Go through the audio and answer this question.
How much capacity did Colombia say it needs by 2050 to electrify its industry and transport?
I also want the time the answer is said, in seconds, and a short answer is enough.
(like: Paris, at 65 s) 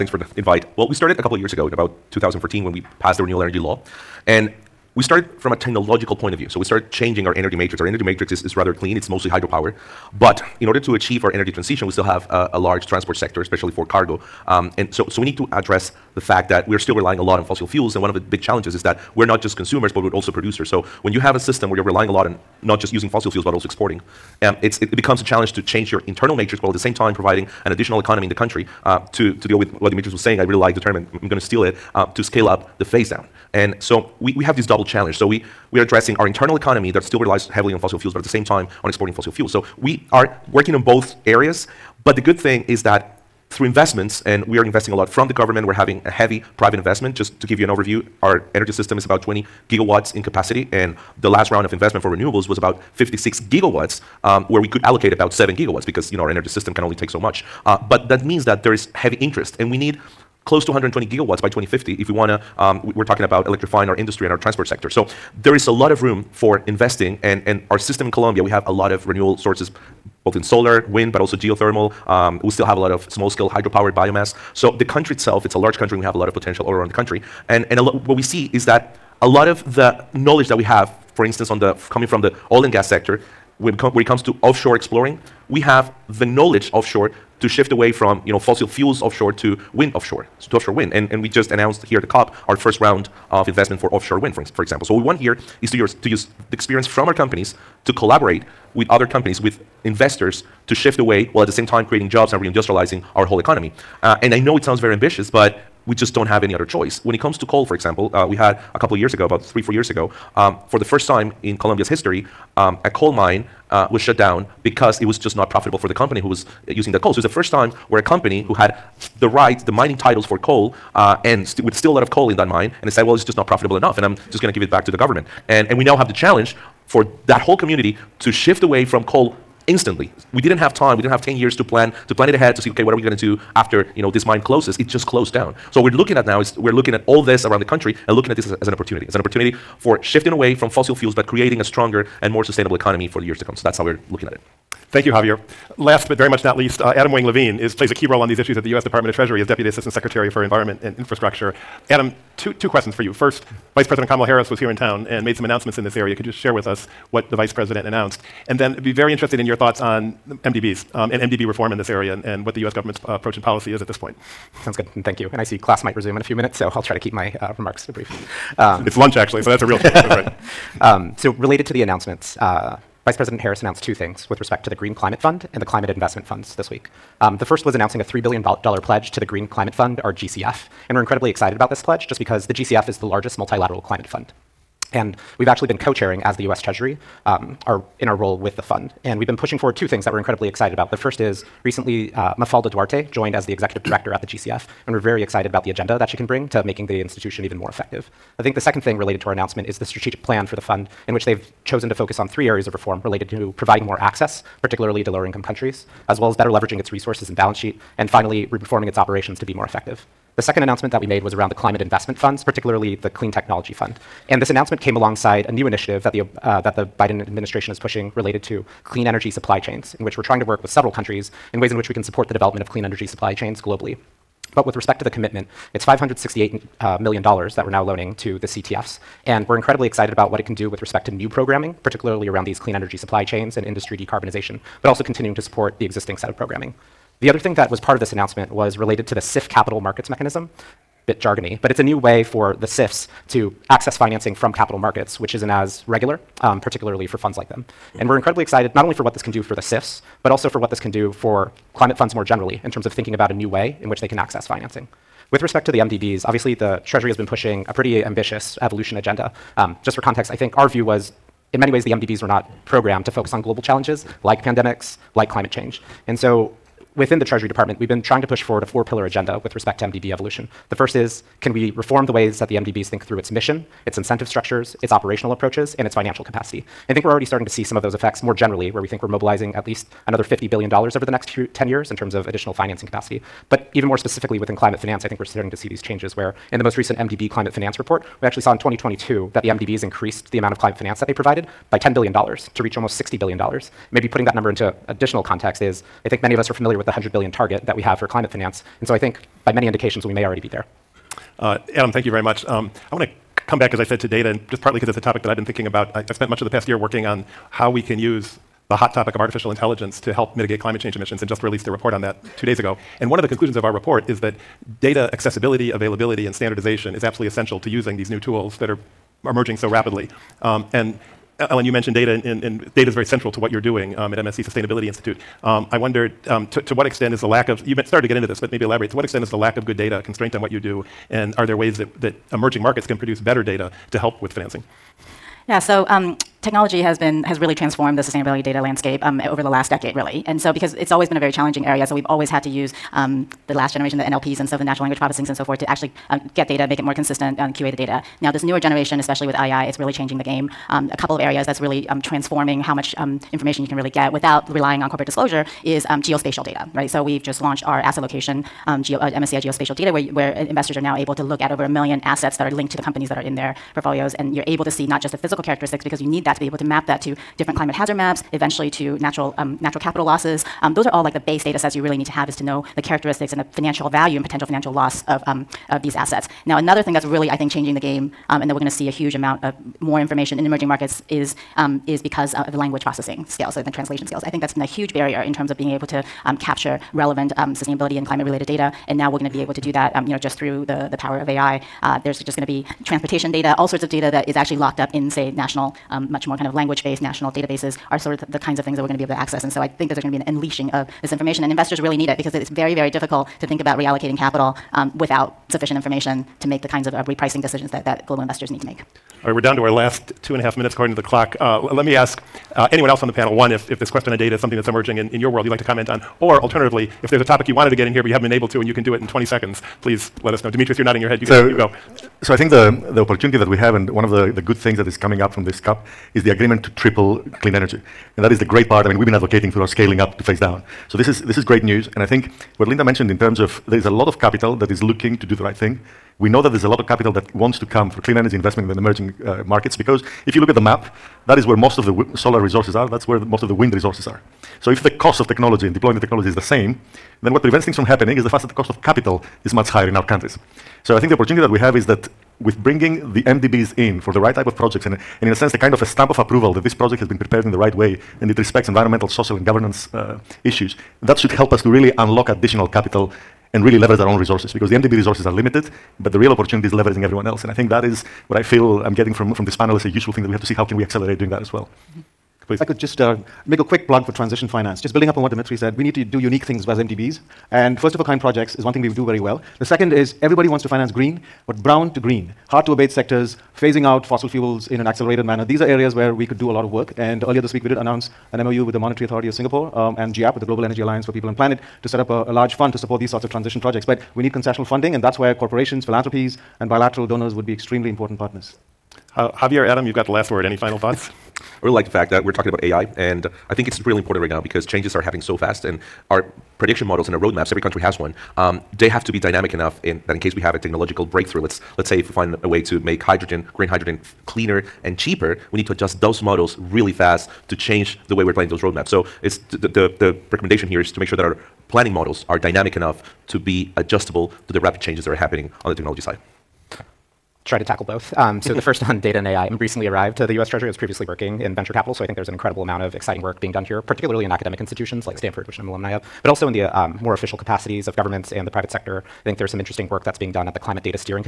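120 gigawatts, at 60 s.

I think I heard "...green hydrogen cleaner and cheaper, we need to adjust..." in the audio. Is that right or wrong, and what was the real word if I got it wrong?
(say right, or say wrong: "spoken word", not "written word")
right.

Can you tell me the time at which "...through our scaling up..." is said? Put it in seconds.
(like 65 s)
429 s.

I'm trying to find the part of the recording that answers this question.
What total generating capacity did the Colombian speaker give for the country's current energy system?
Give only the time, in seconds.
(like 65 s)
49 s.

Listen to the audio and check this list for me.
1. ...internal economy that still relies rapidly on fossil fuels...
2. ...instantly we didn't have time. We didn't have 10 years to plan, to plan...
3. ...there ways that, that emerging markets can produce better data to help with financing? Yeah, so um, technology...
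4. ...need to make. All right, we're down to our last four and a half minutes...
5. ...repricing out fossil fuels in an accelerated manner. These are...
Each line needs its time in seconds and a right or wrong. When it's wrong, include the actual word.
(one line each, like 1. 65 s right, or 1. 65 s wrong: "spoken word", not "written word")
1. 36 s wrong: "heavily", not "rapidly"
2. 129 s right
3. 331 s right
4. 408 s wrong: "two", not "four"
5. 483 s wrong: "phasing", not "repricing".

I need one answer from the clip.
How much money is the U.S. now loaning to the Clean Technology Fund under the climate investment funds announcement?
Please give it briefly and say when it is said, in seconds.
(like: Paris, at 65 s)
$568 million, at 225 s.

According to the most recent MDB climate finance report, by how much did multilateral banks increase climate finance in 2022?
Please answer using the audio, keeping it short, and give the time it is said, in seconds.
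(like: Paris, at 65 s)
$10 billion, at 291 s.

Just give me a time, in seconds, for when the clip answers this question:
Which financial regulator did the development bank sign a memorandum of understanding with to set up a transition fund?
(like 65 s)
488 s.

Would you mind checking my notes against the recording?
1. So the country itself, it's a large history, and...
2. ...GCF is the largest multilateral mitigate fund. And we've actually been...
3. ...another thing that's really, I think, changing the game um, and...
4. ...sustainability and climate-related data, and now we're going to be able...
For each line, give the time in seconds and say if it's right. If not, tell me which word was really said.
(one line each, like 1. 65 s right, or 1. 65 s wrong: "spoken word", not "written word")
1. 74 s wrong: "country", not "history"
2. 182 s wrong: "climate", not "mitigate"
3. 376 s right
4. 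387 s right.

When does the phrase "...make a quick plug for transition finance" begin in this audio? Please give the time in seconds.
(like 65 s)
473 s.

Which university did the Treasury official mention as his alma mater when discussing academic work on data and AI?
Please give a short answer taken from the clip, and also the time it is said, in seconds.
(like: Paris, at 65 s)
Stanford, at 535 s.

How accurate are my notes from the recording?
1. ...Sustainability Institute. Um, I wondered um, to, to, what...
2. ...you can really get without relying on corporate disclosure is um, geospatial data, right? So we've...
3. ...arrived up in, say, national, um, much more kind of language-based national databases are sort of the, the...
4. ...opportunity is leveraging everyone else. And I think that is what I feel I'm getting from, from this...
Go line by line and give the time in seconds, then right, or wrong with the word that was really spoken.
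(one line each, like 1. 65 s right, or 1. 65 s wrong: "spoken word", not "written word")
1. 324 s right
2. 353 s right
3. 394 s wrong: "locked", not "arrived"
4. 466 s right.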